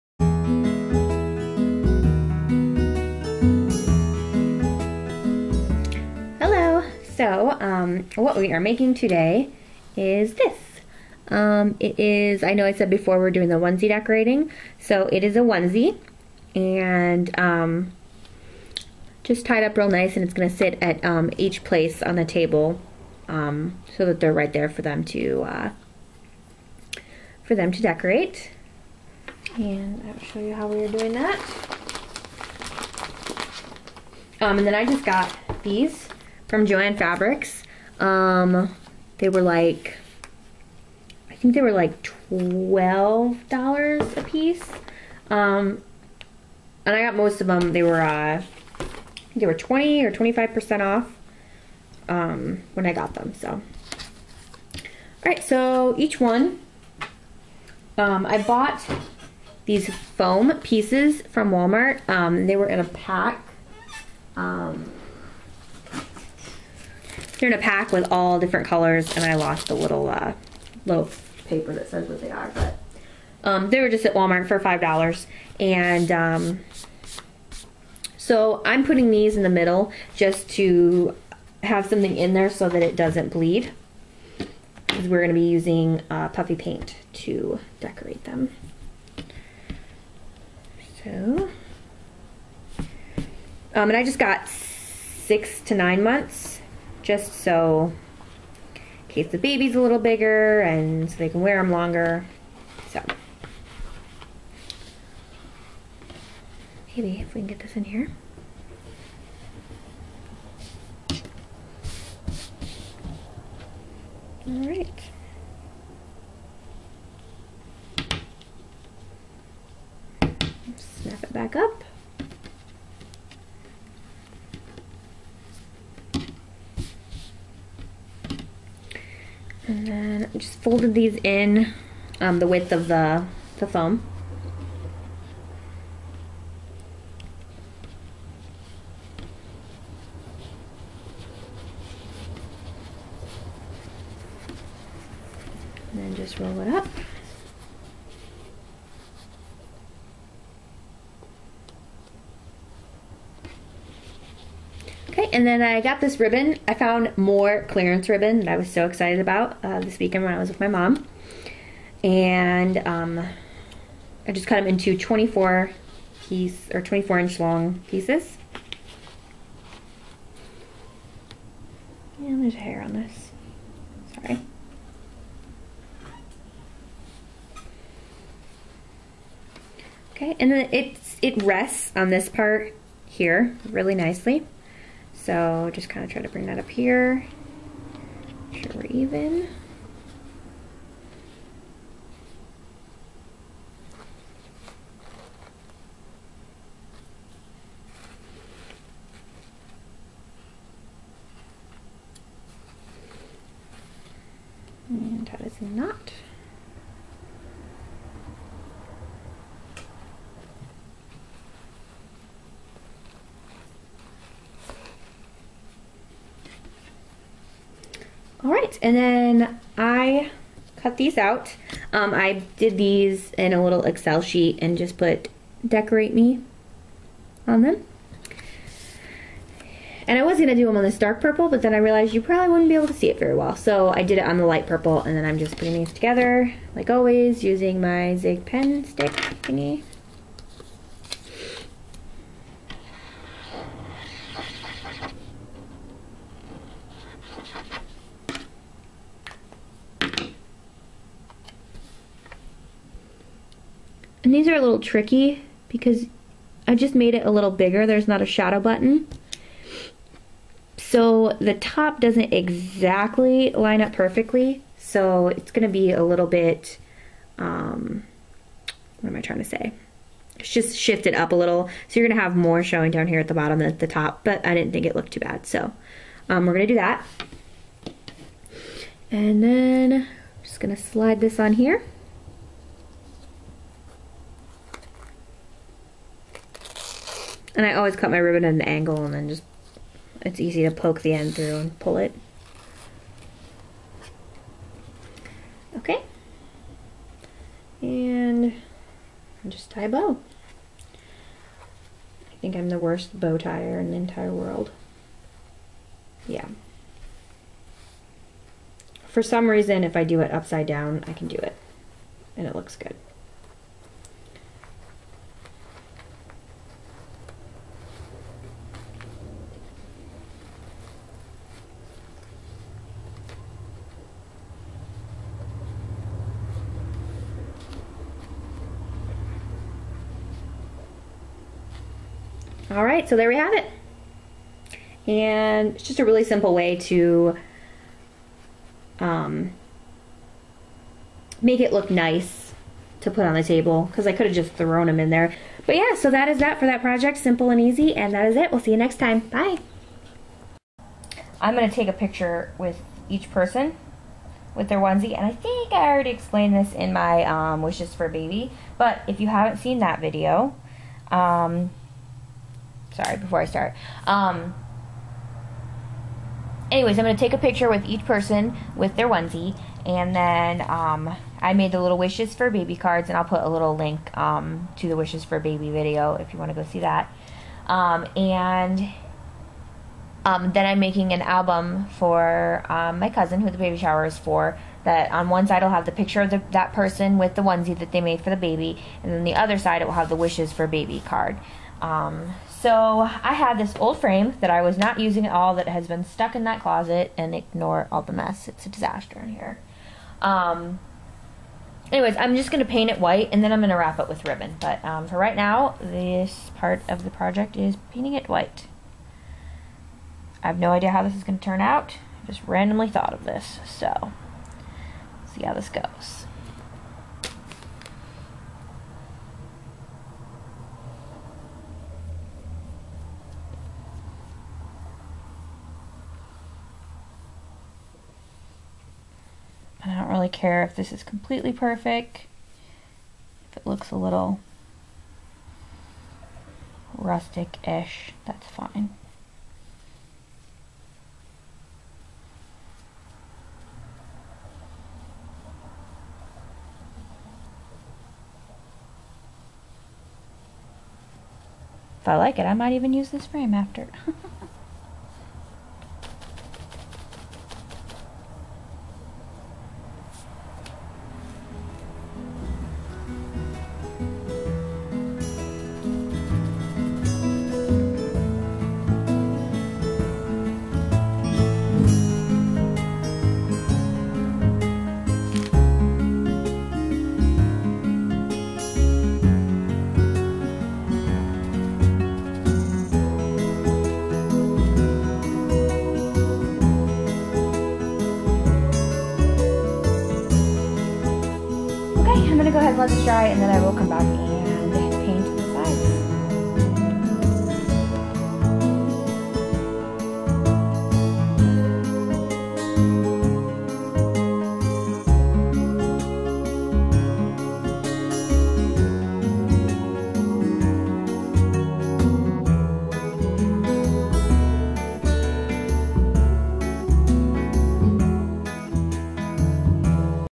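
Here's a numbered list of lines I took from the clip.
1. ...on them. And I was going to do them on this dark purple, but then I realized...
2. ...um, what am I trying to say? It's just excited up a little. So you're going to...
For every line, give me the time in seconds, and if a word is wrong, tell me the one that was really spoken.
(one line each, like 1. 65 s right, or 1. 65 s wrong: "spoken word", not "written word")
1. 227 s right
2. 267 s wrong: "shifted", not "excited".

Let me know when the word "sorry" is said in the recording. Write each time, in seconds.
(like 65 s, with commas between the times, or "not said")
174 s, 362 s.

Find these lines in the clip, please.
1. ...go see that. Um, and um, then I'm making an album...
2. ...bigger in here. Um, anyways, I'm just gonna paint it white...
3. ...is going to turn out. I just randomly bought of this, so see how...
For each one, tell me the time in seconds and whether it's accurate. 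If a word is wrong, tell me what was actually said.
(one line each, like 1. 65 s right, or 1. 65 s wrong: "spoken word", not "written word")
1. 376 s right
2. 398 s wrong: "disaster", not "bigger"
3. 411 s wrong: "thought", not "bought".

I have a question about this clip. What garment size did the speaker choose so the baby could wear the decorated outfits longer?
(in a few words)
6 to 9 months.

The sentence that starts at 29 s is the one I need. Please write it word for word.
And I'll show you how we are doing that.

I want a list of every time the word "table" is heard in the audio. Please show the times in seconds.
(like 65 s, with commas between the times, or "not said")
22 s, 343 s.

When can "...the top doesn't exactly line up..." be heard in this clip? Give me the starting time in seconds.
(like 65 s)
261 s.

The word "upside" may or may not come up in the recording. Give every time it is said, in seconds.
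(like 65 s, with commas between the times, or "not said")
310 s.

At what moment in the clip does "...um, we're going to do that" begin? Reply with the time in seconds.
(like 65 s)
276 s.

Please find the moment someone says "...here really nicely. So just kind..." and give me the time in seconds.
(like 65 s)
183 s.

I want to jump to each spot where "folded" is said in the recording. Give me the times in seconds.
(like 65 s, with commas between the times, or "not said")
130 s.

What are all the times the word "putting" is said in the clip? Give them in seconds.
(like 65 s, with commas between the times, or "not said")
78 s, 235 s.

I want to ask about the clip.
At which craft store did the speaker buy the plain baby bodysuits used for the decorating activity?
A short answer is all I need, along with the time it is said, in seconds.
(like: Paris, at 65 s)
Joann Fabrics, at 36 s.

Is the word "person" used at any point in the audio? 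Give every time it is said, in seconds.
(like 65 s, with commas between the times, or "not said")
353 s, 368 s, 386 s.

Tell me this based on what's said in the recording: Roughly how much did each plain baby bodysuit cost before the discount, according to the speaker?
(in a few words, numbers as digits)
$12.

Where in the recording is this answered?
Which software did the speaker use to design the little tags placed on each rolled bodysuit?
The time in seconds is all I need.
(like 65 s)
223 s.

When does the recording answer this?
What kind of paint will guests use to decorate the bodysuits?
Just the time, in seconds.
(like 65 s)
86 s.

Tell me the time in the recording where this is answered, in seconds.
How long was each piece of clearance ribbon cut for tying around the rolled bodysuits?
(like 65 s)
166 s.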